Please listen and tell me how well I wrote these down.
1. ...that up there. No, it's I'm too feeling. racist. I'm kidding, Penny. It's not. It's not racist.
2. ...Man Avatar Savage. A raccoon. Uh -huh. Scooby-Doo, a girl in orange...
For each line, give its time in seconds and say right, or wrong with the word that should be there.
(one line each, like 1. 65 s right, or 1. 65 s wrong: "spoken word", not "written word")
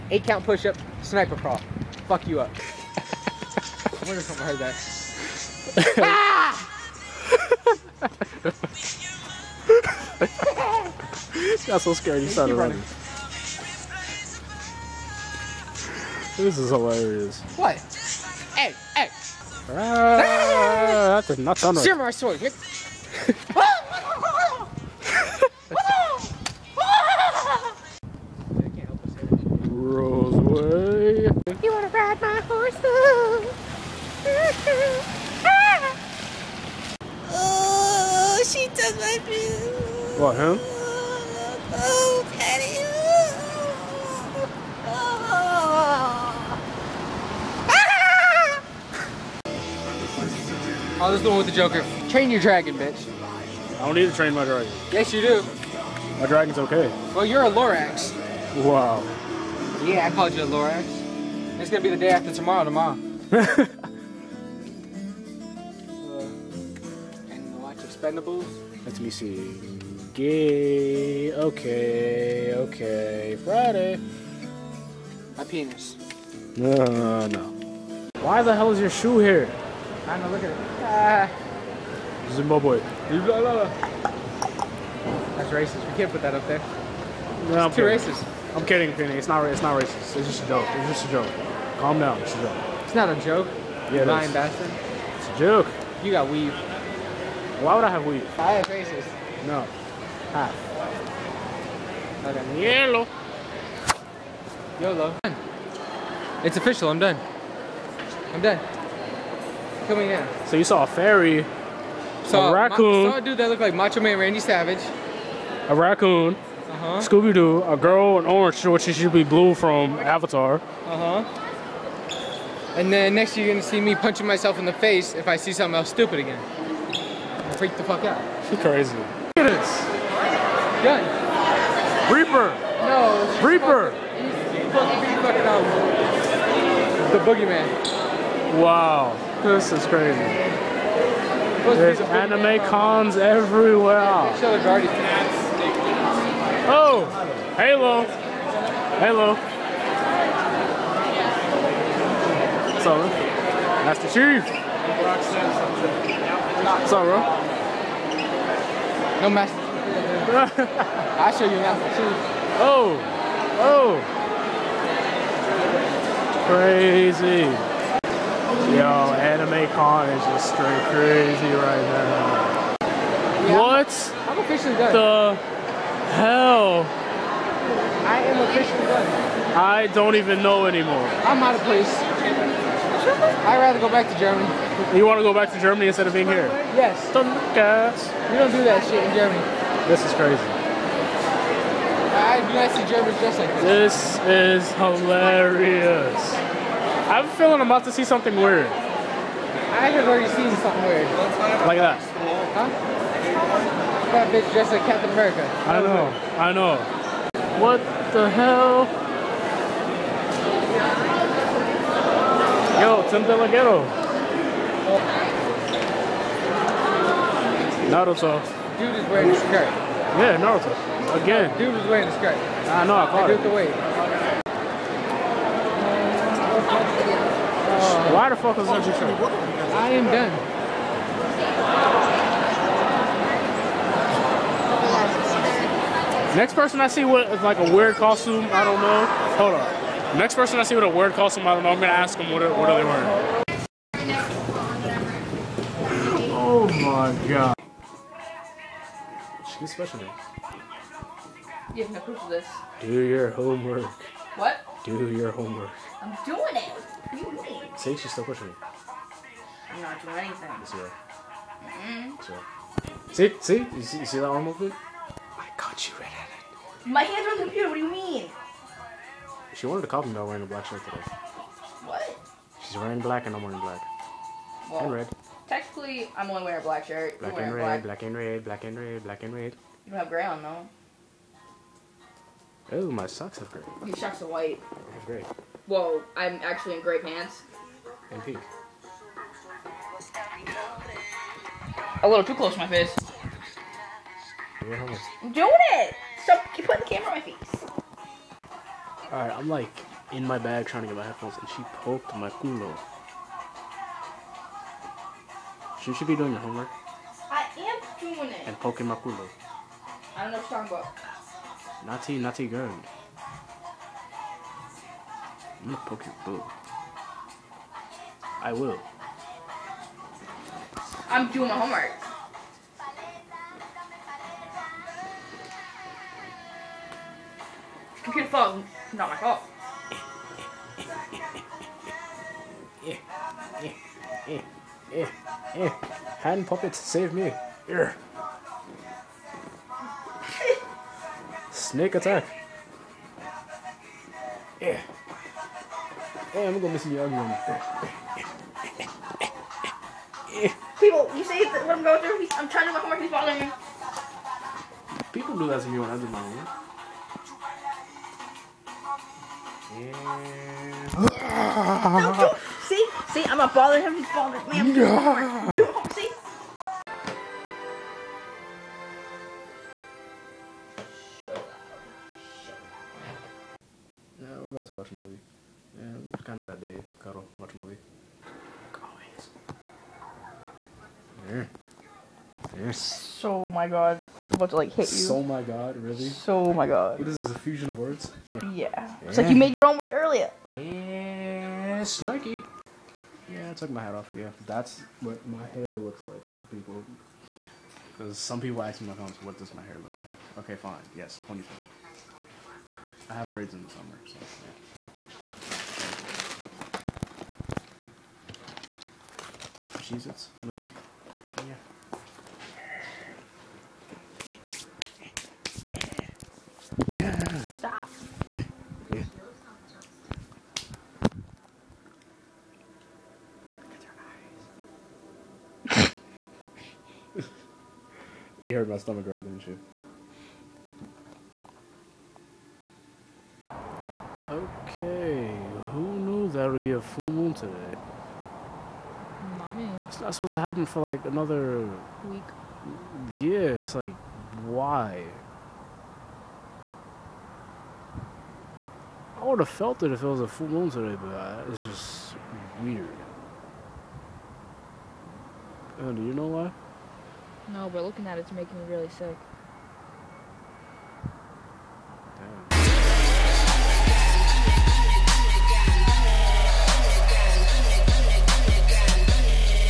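1. 86 s wrong: "kidding", not "feeling"
2. 114 s wrong: "Randy", not "Avatar".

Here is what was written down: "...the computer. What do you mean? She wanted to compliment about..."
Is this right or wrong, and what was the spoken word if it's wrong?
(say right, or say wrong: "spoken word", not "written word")
right.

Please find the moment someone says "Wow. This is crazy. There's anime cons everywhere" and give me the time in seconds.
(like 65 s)
138 s.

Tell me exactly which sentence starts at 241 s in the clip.
I'm gonna ask them what, what are they wearing.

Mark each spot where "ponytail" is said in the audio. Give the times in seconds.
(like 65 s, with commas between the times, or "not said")
401 s.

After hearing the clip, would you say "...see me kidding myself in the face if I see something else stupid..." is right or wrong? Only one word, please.
wrong.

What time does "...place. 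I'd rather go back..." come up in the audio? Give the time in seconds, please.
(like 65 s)
181 s.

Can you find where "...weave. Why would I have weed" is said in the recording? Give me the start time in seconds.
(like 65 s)
96 s.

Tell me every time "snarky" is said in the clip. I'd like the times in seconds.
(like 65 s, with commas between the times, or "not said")
391 s.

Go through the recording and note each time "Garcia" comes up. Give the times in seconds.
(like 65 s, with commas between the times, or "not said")
not said.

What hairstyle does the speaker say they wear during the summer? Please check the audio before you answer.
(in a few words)
Braids.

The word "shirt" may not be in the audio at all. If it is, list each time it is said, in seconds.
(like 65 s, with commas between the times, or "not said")
270 s, 276 s.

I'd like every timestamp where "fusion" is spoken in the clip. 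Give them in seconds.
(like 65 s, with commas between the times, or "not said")
387 s.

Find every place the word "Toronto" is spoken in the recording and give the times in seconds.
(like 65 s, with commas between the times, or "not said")
not said.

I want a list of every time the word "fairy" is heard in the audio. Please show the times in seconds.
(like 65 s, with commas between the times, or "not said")
110 s.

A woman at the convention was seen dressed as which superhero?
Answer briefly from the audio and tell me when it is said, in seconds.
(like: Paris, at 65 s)
Captain America, at 204 s.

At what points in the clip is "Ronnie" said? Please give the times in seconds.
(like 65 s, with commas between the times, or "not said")
not said.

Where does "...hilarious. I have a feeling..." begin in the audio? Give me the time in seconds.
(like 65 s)
194 s.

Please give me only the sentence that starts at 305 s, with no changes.
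You should be doing your homework.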